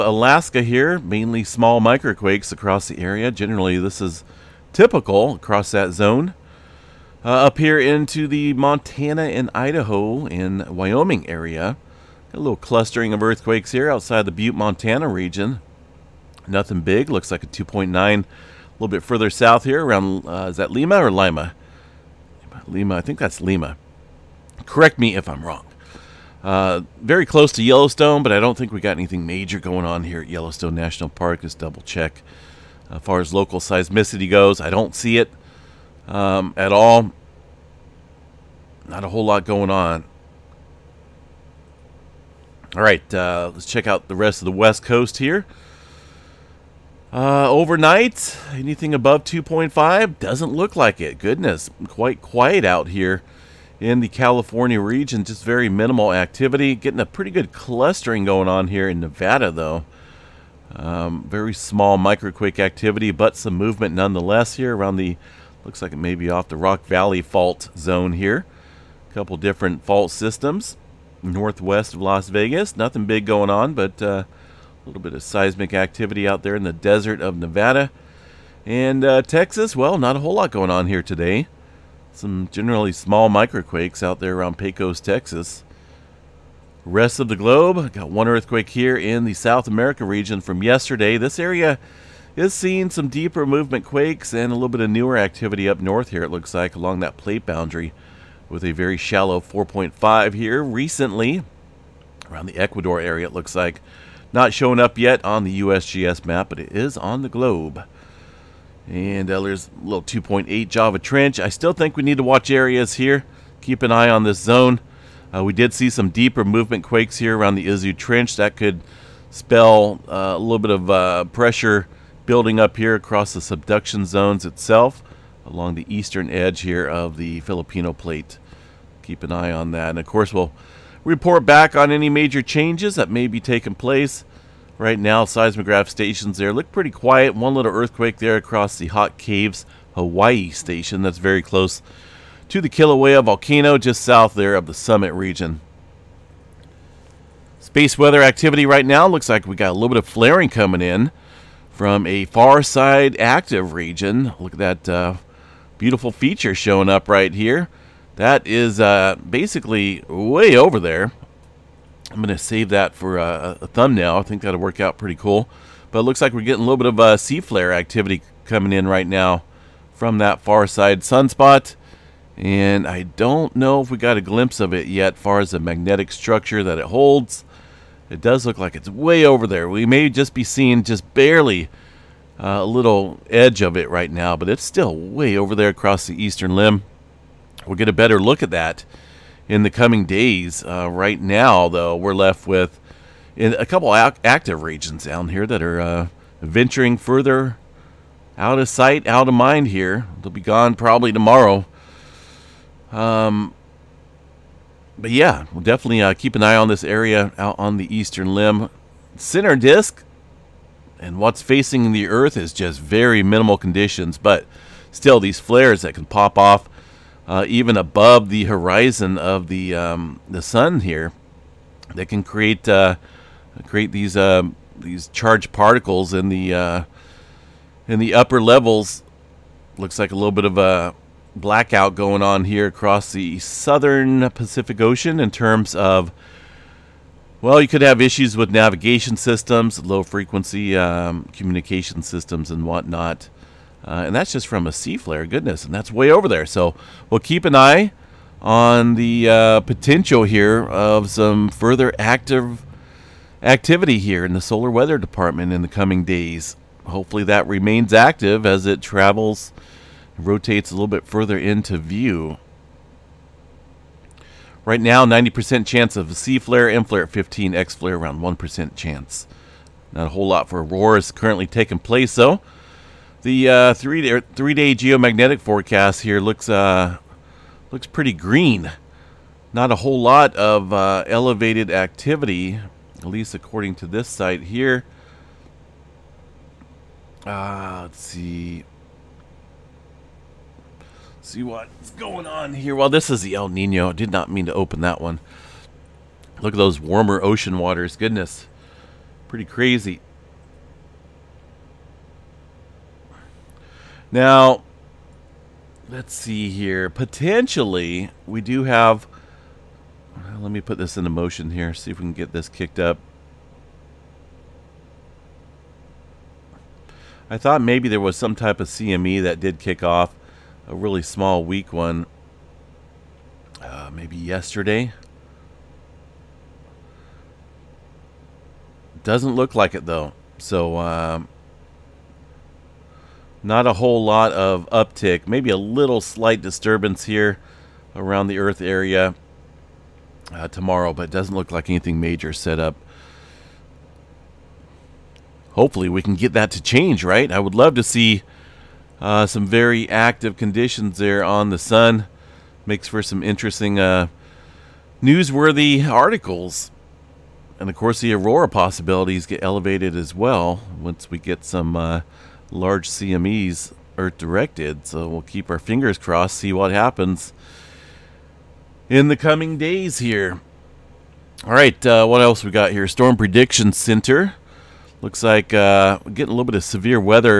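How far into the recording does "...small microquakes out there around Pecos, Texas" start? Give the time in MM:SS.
01:22.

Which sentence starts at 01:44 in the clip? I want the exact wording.
Not showing up yet on the USGS map, but it is on the globe.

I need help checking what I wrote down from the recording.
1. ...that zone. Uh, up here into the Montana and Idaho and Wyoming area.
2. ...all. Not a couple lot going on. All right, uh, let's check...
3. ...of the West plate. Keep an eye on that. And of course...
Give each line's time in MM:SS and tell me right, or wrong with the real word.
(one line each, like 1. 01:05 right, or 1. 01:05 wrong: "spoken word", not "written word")
1. 00:05 right
2. 00:36 wrong: "whole", not "couple"
3. 02:06 wrong: "Filipino", not "West".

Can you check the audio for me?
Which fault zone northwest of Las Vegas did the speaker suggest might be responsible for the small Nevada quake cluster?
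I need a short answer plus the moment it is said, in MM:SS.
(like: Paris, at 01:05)
Rock Valley fault zone, at 01:06.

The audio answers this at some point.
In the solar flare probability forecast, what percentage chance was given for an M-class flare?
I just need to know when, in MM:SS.
04:27.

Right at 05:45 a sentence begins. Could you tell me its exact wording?
Hopefully we can get that to change, right?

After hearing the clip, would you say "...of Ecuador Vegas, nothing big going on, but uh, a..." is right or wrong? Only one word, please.
wrong.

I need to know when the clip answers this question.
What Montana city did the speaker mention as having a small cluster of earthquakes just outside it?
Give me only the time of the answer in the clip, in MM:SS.
00:14.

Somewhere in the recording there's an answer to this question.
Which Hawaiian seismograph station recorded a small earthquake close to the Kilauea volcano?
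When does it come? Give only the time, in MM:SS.
02:18.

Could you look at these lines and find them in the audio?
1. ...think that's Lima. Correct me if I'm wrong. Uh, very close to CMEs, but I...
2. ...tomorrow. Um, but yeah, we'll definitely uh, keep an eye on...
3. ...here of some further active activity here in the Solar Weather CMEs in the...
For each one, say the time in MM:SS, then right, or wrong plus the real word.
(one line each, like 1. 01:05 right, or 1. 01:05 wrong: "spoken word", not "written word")
1. 00:23 wrong: "Yellowstone", not "CMEs"
2. 03:21 right
3. 04:10 wrong: "Department", not "CMEs".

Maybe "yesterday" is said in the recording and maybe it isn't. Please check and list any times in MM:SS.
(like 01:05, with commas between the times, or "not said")
01:30, 05:24.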